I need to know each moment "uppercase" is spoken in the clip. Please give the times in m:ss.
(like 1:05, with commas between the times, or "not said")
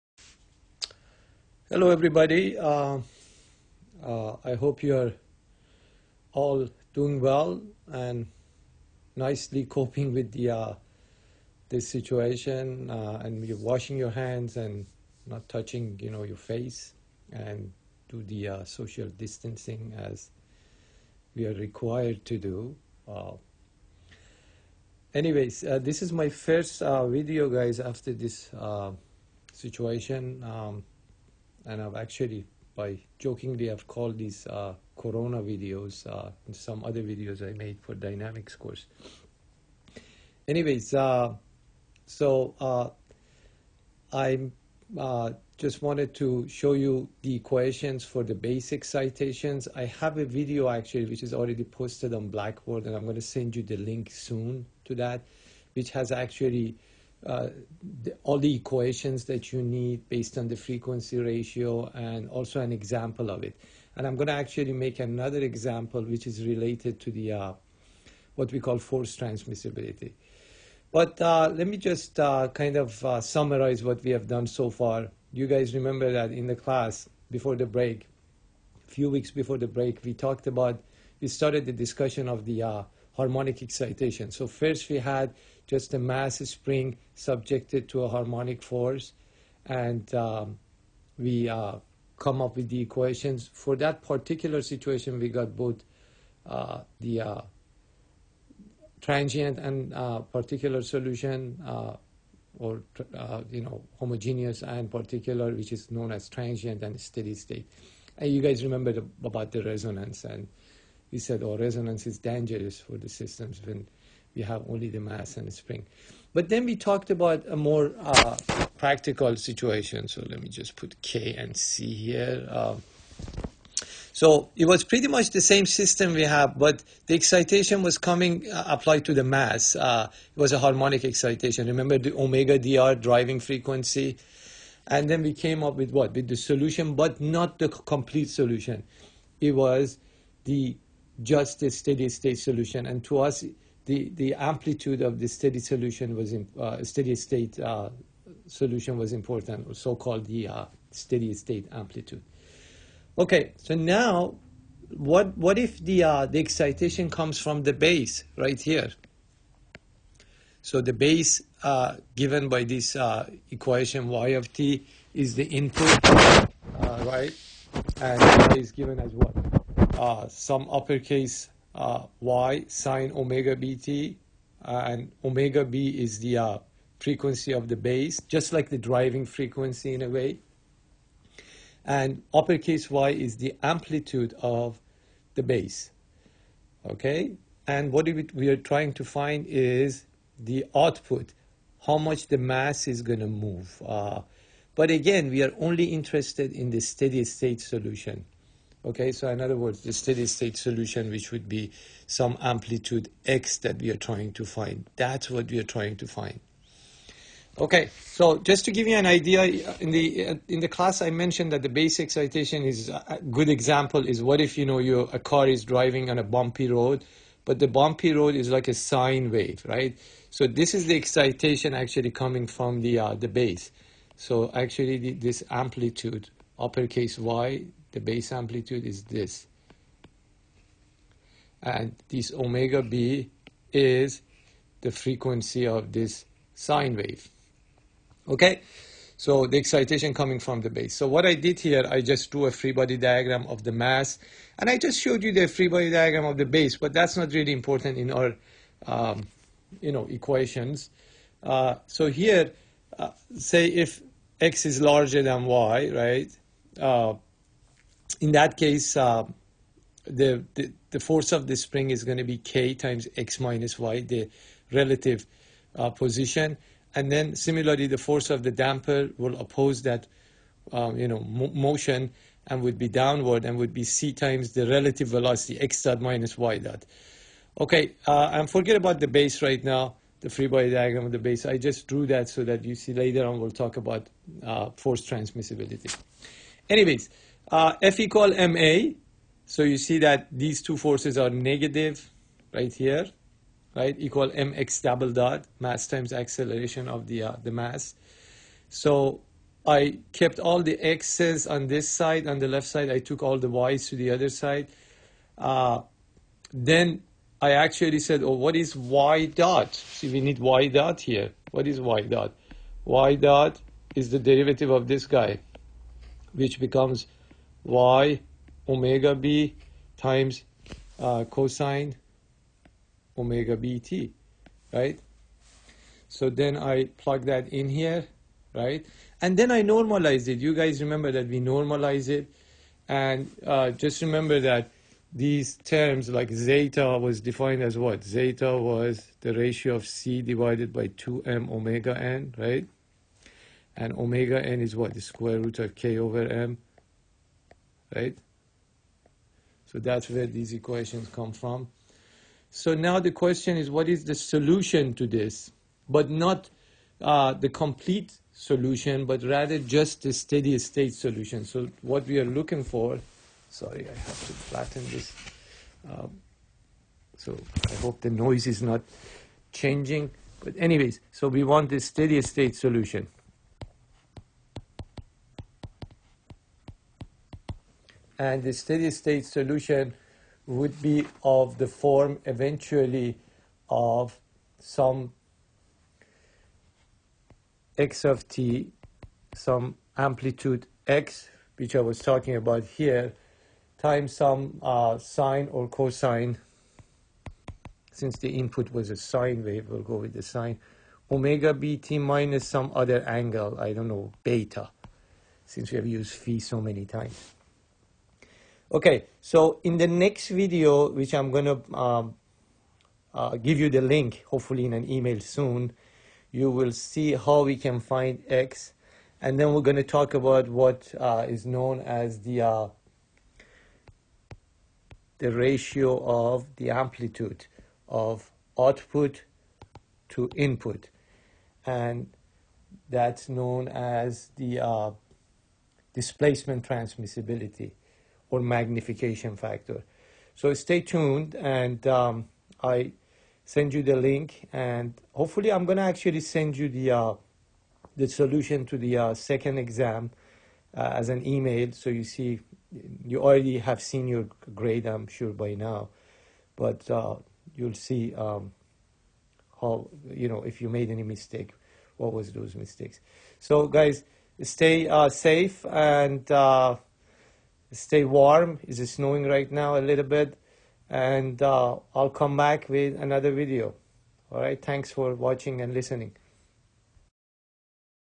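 2:50, 3:02, 3:46.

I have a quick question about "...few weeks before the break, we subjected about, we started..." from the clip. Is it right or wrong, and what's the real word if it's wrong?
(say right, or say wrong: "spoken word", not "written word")
wrong: "talked", not "subjected".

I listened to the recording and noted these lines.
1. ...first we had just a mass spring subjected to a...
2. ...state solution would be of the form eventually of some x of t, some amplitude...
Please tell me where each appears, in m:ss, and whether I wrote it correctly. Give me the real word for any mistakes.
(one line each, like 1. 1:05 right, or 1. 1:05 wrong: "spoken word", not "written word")
1. 1:24 right
2. 6:18 right.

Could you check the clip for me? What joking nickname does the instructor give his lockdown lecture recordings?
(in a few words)
Corona videos.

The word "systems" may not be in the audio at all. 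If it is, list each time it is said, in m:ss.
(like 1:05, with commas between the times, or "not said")
1:53, 2:05.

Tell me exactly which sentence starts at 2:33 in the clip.
Okay, so now what what if the uh, the excitation comes from the base right here?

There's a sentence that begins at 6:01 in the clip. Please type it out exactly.
So what we are looking for, sorry, I have to flatten this.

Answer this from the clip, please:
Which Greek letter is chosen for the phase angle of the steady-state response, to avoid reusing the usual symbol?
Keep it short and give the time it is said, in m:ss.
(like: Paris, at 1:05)
beta, at 6:44.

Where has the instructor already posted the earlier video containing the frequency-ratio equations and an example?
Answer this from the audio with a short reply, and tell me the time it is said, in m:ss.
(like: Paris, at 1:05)
Blackboard, at 0:52.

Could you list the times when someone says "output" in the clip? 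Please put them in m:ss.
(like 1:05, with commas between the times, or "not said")
3:10, 7:08.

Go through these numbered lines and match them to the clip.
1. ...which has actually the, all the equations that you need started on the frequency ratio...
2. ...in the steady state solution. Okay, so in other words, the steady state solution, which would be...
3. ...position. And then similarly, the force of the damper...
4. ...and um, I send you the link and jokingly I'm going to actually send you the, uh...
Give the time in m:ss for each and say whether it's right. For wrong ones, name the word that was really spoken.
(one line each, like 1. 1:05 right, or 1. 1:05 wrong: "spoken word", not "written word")
1. 0:55 wrong: "based", not "started"
2. 3:16 right
3. 4:25 right
4. 7:21 wrong: "hopefully", not "jokingly".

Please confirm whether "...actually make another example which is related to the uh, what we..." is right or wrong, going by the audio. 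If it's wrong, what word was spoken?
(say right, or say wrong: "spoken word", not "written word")
right.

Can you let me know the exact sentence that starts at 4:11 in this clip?
Uh, so here, uh, say if x is larger than y, right?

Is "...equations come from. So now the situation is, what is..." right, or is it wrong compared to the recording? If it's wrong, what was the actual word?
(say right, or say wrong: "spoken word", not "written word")
wrong: "question", not "situation".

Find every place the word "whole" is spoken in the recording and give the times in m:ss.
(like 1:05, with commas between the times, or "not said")
not said.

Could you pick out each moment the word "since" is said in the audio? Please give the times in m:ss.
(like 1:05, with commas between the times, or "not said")
6:37, 6:45.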